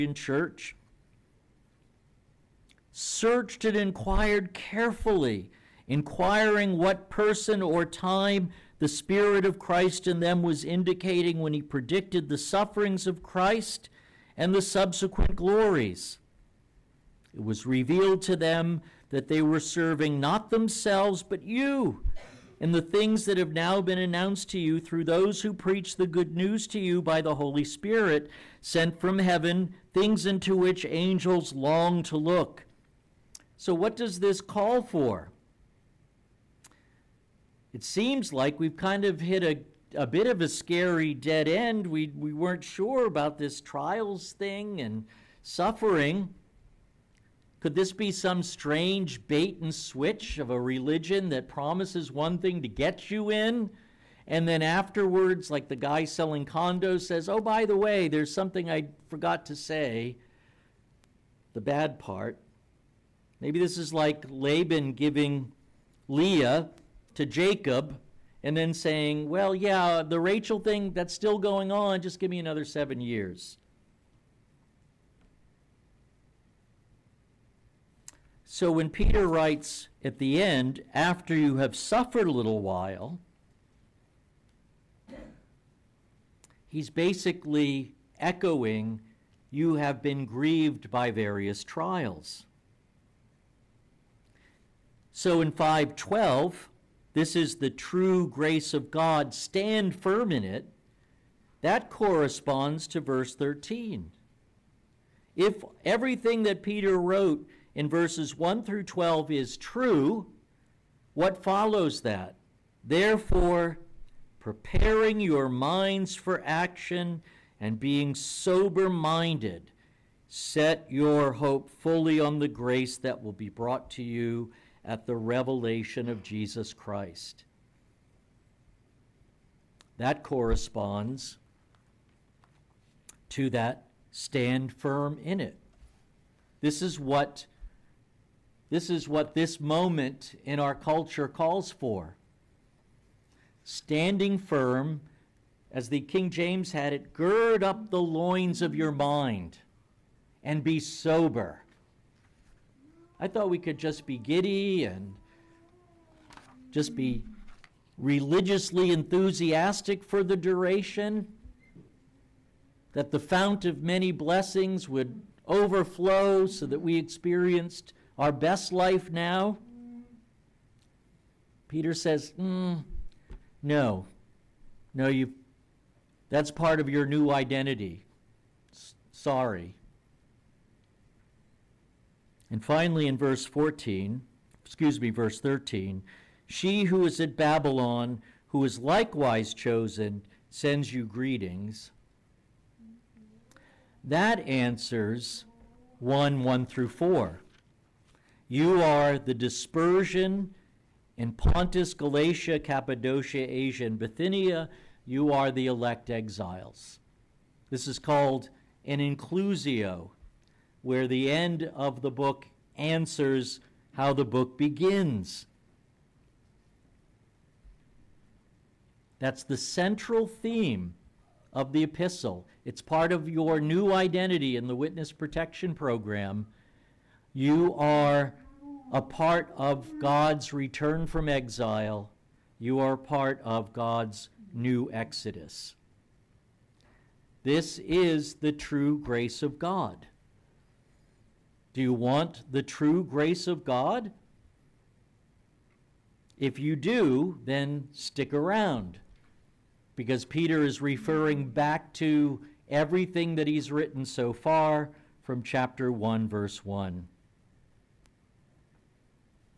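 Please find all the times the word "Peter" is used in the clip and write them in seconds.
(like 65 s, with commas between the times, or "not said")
78 s, 106 s, 171 s, 250 s.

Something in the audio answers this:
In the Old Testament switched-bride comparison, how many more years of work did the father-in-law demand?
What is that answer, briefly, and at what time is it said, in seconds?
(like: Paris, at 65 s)
7, at 72 s.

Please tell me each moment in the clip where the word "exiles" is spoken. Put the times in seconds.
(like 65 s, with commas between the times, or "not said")
206 s, 231 s.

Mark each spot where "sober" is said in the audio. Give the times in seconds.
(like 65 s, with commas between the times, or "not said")
118 s, 150 s.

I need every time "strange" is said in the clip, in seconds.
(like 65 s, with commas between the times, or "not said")
48 s.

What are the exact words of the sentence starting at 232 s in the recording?
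You are part of God's new exodus.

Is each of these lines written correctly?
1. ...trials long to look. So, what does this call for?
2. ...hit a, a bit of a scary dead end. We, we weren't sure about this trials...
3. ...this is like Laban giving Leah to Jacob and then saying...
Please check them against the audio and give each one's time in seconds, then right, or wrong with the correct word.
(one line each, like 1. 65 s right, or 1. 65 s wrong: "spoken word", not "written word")
1. 30 s wrong: "angels", not "trials"
2. 39 s right
3. 63 s right.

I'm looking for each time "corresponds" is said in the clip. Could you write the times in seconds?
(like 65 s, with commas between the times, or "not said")
101 s, 130 s.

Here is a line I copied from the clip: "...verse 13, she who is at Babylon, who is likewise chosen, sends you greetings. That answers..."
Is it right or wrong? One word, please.
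right.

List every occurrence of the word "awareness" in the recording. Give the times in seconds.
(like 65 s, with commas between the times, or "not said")
not said.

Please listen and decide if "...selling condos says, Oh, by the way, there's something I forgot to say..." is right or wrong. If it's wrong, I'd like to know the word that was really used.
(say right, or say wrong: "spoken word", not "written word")
right.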